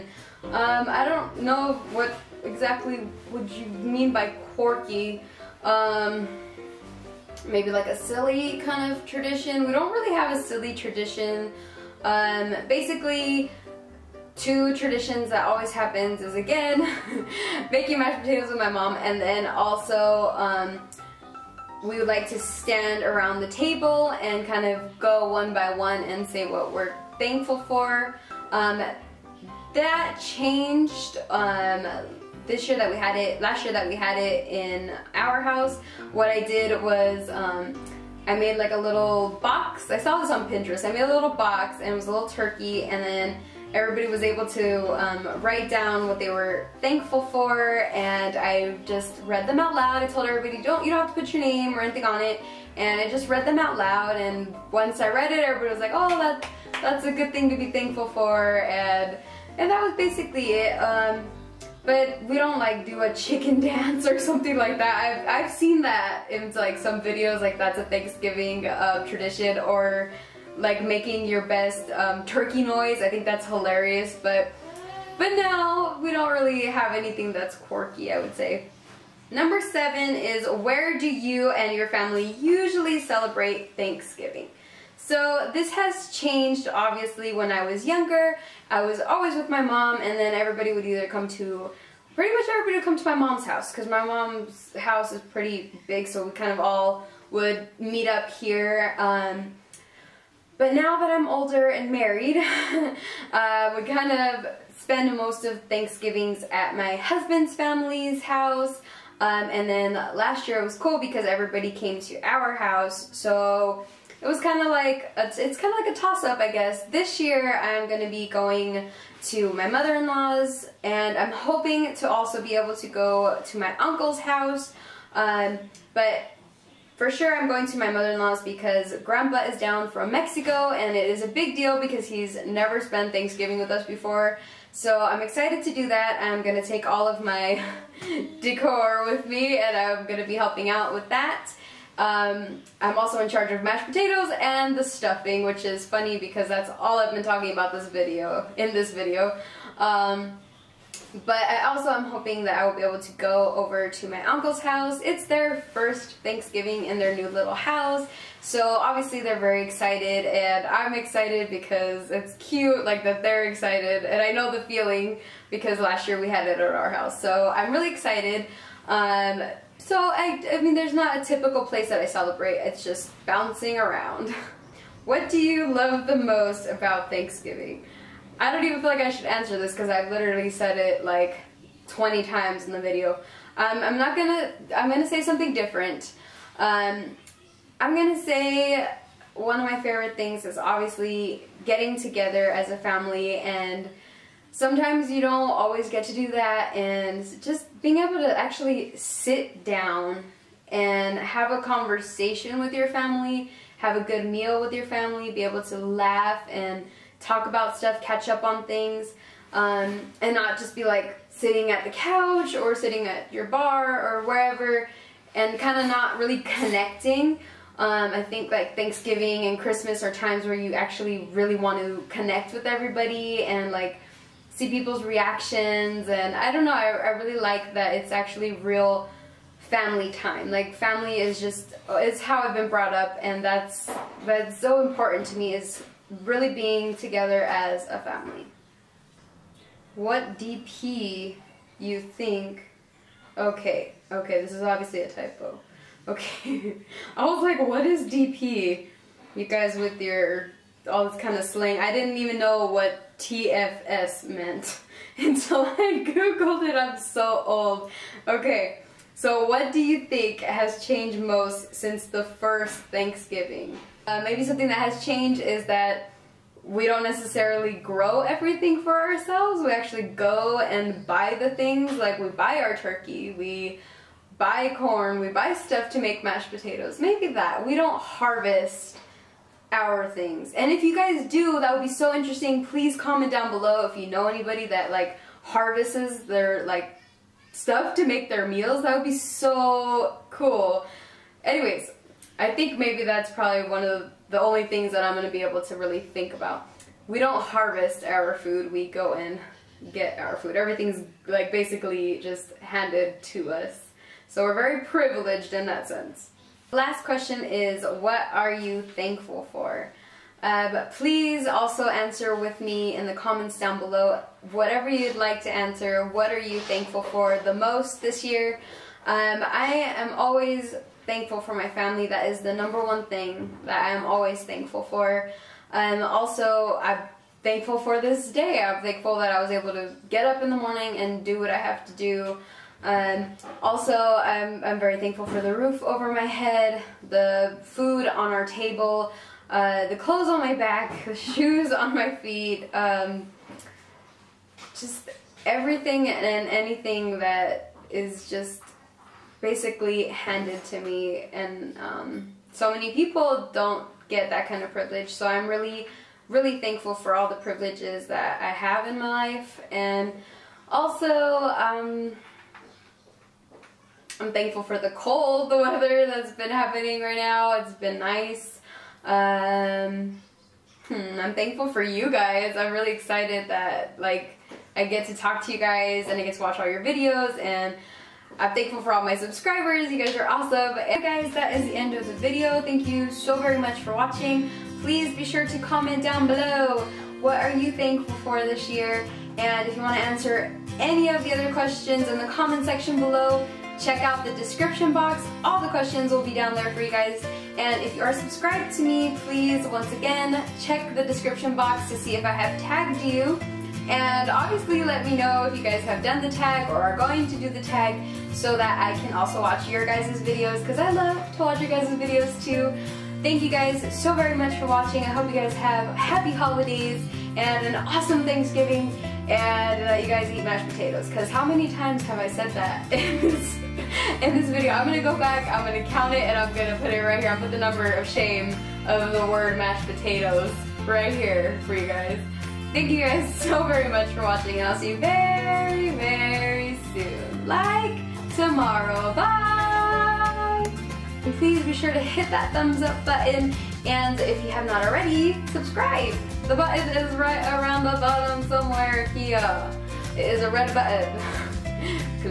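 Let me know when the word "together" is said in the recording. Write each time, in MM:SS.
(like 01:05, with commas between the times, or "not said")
03:11, 03:56.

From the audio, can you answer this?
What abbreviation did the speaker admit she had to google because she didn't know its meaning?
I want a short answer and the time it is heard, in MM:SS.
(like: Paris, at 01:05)
TFS, at 04:13.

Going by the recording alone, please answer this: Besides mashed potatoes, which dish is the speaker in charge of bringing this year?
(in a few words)
stuffing.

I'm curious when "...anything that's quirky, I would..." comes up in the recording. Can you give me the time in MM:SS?
01:16.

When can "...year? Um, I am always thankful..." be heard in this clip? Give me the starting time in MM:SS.
05:18.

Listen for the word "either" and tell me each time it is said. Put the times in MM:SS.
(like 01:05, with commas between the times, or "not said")
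01:30.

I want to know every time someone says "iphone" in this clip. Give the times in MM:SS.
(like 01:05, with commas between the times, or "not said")
not said.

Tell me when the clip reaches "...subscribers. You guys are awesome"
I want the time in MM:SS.
06:19.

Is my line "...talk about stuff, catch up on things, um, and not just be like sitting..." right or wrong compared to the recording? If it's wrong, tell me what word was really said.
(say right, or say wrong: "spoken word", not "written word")
right.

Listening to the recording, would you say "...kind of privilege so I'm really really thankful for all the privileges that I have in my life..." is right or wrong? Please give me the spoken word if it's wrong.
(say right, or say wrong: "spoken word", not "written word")
right.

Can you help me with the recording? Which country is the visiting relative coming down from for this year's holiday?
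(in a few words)
Mexico.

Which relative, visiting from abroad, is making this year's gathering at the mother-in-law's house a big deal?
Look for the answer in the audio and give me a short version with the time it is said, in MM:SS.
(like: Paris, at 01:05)
Grandpa, at 02:09.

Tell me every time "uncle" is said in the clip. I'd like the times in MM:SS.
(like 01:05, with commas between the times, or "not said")
02:03, 02:34.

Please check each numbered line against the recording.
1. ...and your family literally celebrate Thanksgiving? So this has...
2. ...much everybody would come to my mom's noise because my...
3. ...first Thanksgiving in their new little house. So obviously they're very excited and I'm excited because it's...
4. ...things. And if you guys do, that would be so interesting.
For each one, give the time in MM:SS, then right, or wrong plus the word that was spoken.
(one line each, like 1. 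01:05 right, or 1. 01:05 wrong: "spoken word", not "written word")
1. 01:21 wrong: "usually", not "literally"
2. 01:32 wrong: "house", not "noise"
3. 02:35 right
4. 04:40 right.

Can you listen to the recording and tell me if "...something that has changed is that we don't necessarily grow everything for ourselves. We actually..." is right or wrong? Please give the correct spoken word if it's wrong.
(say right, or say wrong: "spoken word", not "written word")
right.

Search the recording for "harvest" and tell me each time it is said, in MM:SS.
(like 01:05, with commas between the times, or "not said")
04:37, 04:45, 04:57.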